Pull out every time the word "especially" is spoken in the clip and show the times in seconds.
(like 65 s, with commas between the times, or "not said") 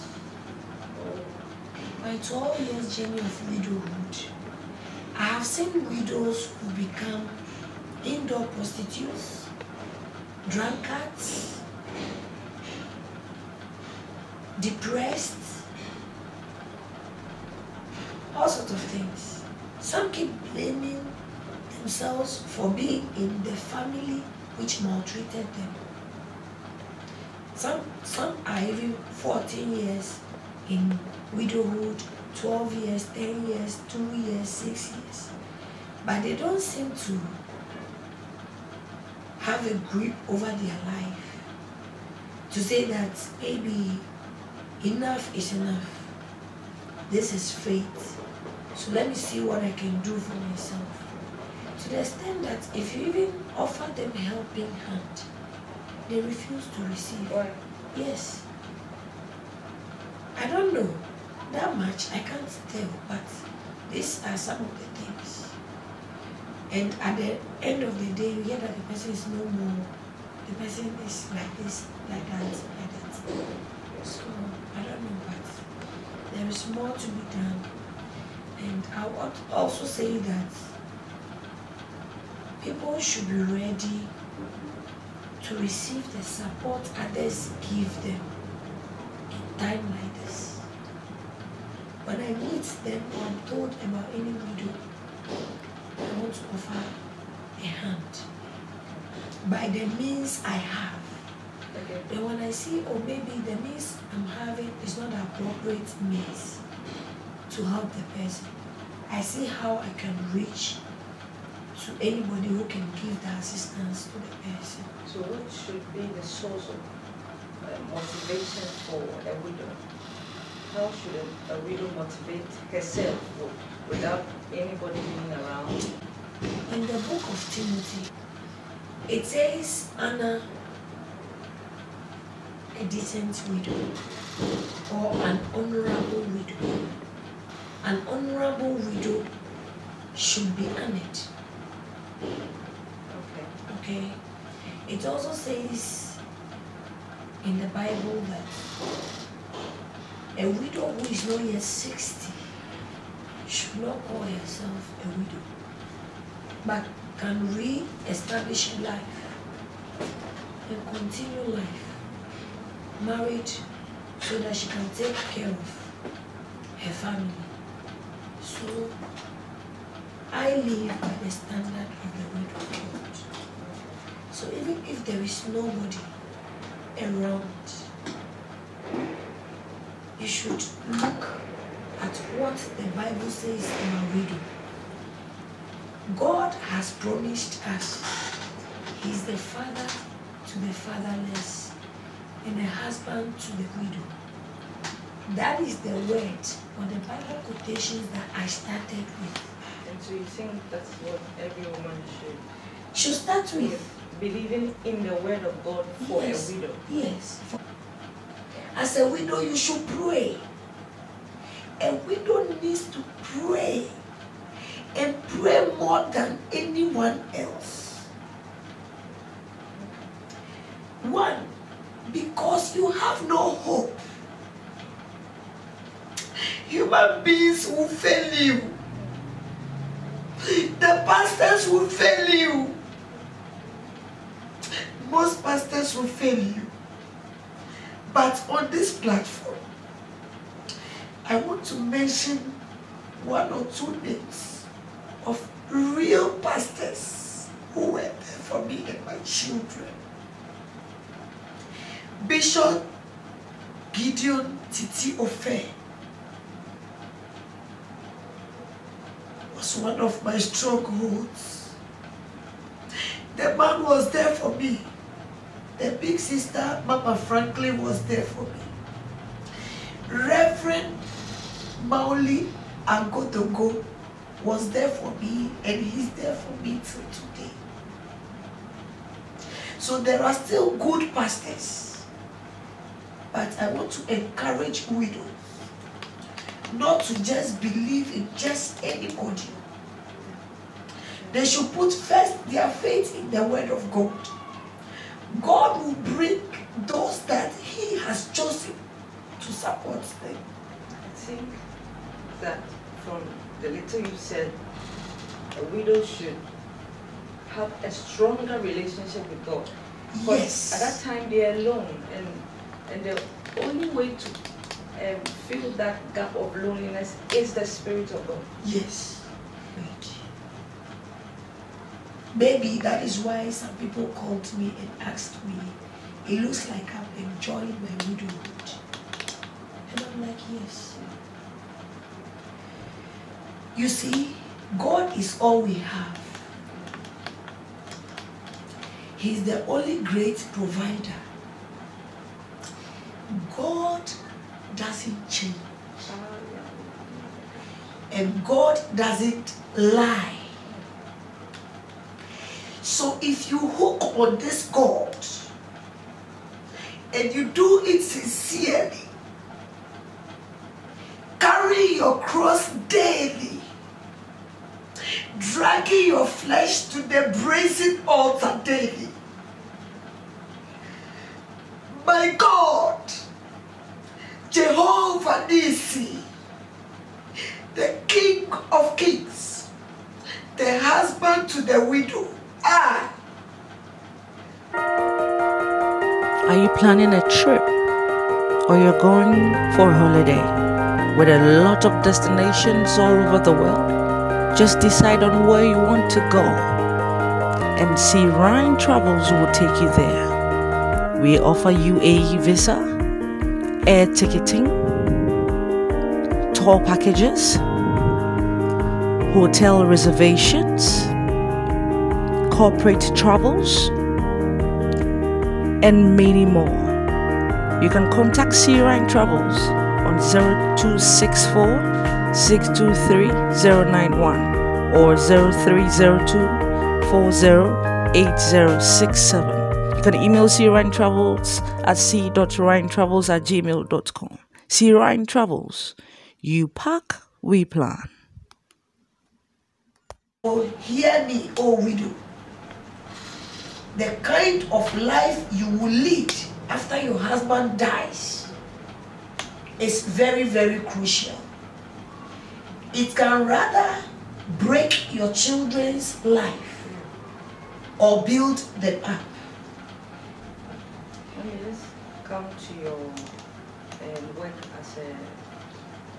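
not said.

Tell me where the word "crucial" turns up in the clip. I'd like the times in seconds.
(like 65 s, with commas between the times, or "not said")
450 s.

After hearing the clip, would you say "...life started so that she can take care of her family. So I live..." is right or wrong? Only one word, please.
wrong.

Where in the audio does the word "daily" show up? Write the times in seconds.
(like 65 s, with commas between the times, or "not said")
362 s, 368 s.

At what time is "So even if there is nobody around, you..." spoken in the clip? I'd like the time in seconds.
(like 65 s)
174 s.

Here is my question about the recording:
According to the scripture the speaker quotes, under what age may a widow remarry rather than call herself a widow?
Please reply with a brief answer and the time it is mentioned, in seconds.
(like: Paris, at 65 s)
60, at 151 s.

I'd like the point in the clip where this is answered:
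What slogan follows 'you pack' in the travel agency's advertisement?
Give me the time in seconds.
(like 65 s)
437 s.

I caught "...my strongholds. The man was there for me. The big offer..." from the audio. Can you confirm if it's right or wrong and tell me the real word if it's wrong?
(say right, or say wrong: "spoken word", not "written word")
wrong: "sister", not "offer".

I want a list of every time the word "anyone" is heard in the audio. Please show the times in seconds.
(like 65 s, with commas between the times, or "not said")
216 s.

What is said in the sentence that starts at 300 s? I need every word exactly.
I think that from the little you said, a widow should have a stronger relationship with God.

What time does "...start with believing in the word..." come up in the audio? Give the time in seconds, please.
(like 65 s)
203 s.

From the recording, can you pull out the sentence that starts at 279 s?
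So there are still good pastors.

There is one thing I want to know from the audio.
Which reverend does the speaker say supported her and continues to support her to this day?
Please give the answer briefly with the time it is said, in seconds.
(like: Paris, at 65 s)
Mauli Agodogo, at 271 s.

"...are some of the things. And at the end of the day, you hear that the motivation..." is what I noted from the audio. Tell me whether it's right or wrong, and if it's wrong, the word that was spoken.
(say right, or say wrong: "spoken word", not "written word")
wrong: "person", not "motivation".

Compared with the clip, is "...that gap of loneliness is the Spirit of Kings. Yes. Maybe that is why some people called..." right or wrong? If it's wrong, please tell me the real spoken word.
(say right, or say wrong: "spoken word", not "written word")
wrong: "God", not "Kings".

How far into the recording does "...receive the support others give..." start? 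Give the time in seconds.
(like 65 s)
85 s.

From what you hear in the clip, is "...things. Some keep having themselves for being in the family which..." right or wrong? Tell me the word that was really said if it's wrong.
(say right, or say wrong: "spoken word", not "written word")
wrong: "blaming", not "having".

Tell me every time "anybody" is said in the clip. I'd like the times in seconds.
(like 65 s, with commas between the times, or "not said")
112 s, 124 s, 288 s.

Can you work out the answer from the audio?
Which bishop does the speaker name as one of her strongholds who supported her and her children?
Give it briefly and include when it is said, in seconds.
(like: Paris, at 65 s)
Gideon Titi-Offei, at 253 s.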